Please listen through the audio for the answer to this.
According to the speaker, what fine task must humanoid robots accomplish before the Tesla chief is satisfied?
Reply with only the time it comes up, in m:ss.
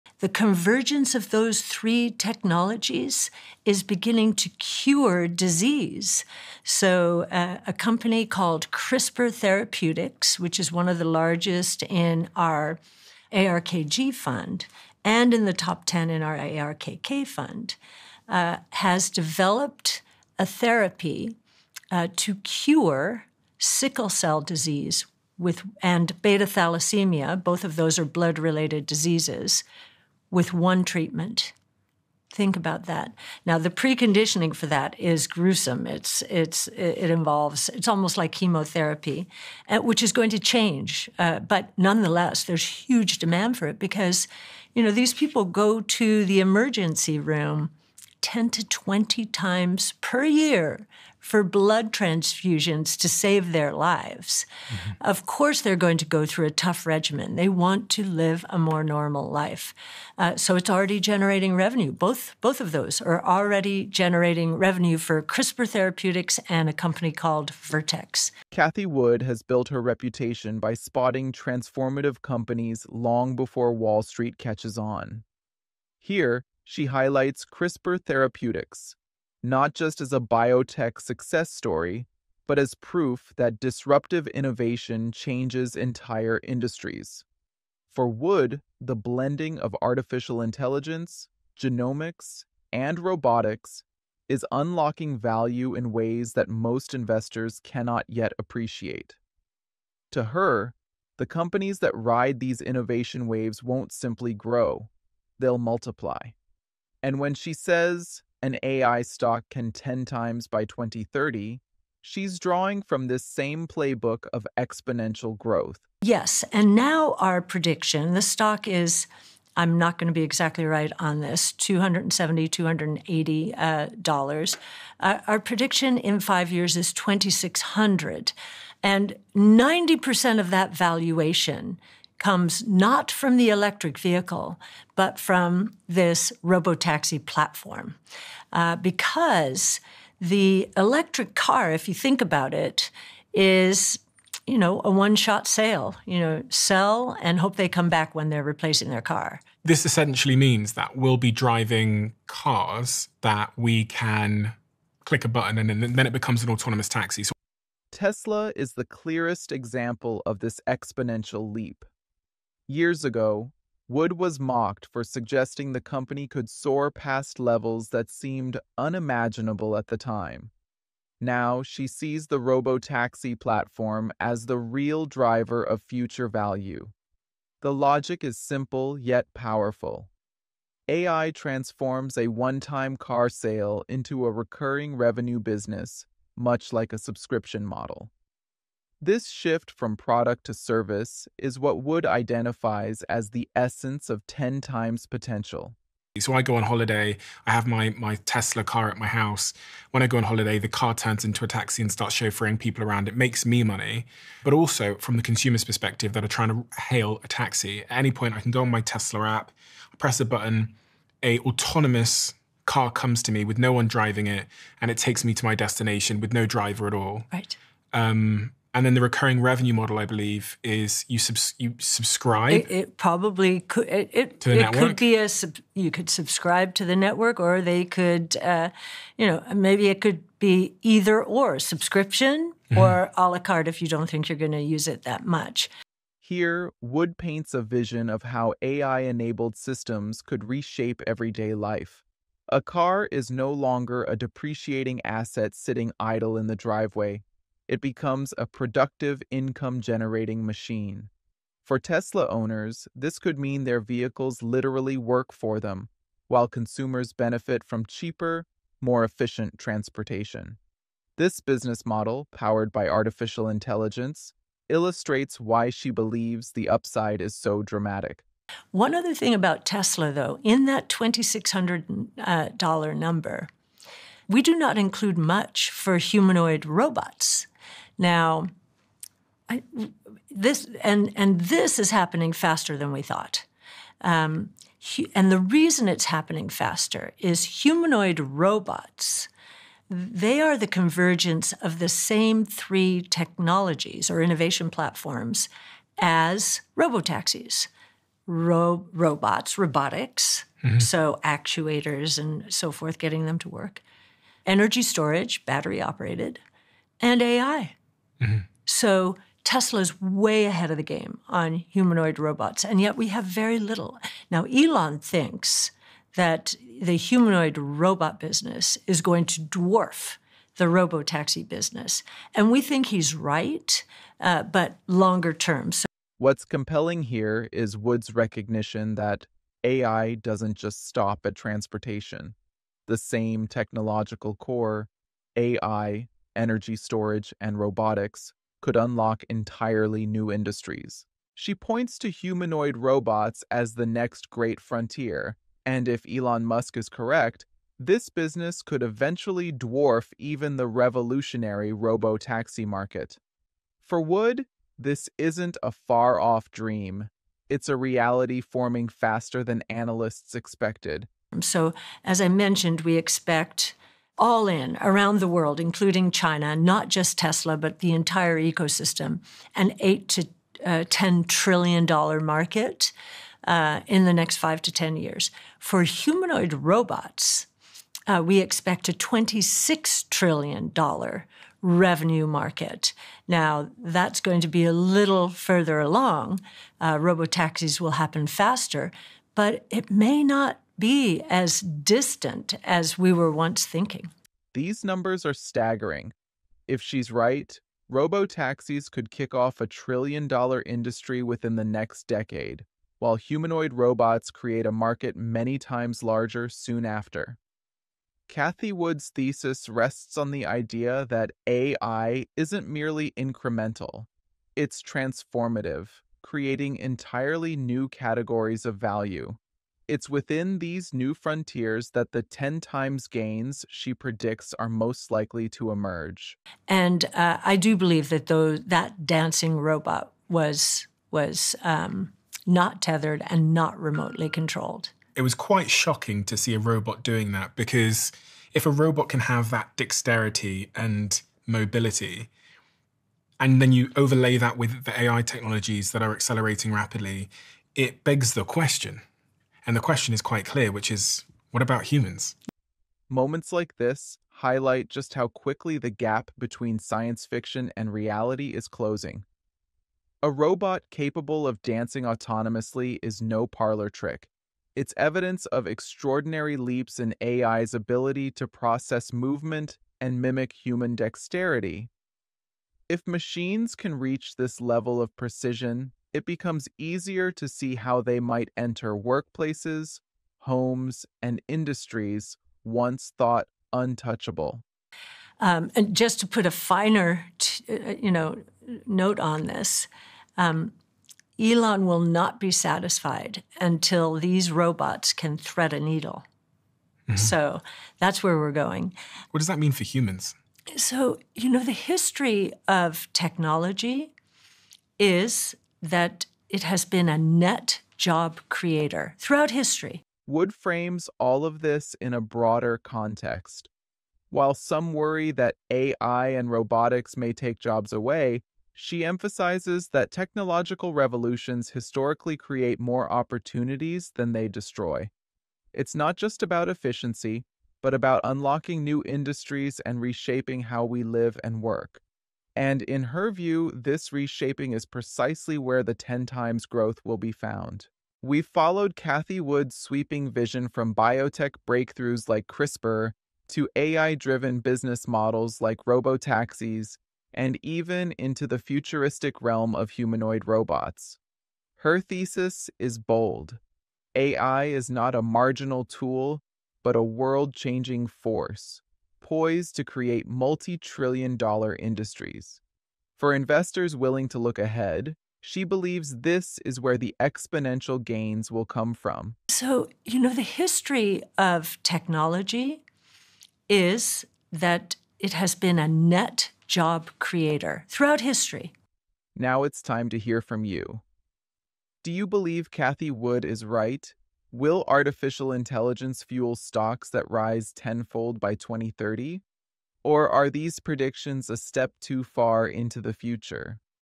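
8:15.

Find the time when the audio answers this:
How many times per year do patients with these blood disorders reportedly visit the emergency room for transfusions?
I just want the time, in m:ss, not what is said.
0:48.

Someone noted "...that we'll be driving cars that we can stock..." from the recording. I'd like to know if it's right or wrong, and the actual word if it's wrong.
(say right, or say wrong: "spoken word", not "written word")
wrong: "click", not "stock".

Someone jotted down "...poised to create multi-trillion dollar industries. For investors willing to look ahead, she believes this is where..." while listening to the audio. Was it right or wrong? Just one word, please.
right.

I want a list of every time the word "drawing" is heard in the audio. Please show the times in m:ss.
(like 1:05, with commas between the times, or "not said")
1:52.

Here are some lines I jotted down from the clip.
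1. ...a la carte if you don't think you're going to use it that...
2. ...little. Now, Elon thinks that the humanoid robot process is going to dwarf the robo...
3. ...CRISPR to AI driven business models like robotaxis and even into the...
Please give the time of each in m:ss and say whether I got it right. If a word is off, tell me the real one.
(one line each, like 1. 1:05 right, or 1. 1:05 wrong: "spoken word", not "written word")
1. 3:53 right
2. 5:13 wrong: "business", not "process"
3. 9:02 right.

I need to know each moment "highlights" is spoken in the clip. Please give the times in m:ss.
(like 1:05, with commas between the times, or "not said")
1:16, 7:34.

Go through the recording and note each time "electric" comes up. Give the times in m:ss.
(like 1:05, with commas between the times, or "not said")
2:13, 2:20.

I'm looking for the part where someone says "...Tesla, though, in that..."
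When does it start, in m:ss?
4:29.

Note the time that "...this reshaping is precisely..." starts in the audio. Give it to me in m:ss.
8:53.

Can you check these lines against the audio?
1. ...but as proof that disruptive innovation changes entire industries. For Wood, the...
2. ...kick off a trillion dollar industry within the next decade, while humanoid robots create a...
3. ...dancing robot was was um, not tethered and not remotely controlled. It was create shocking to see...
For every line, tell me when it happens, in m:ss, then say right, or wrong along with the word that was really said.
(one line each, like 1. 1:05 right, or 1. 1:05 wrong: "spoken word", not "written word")
1. 1:22 right
2. 6:39 right
3. 7:09 wrong: "quite", not "create".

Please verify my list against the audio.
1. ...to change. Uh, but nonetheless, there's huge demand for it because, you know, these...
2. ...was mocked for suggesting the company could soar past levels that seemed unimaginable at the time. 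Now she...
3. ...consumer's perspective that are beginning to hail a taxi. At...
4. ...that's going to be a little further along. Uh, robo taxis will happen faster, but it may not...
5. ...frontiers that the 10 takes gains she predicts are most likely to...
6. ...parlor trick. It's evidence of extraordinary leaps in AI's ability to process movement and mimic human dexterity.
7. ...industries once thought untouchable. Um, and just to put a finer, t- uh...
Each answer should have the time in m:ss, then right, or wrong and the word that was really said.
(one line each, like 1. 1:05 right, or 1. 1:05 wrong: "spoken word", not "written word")
1. 0:40 right
2. 2:44 right
3. 3:25 wrong: "trying", not "beginning"
4. 6:23 right
5. 7:01 wrong: "times", not "takes"
6. 7:43 right
7. 8:01 right.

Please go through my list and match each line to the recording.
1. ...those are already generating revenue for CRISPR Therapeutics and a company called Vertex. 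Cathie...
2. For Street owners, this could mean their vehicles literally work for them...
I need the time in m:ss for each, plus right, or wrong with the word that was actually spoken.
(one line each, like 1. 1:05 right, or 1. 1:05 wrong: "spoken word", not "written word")
1. 1:02 right
2. 4:11 wrong: "Tesla", not "Street".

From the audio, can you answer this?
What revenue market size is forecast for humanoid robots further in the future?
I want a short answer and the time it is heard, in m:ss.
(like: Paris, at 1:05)
26 trillion dollars, at 6:18.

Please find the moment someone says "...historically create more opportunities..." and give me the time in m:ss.
8:41.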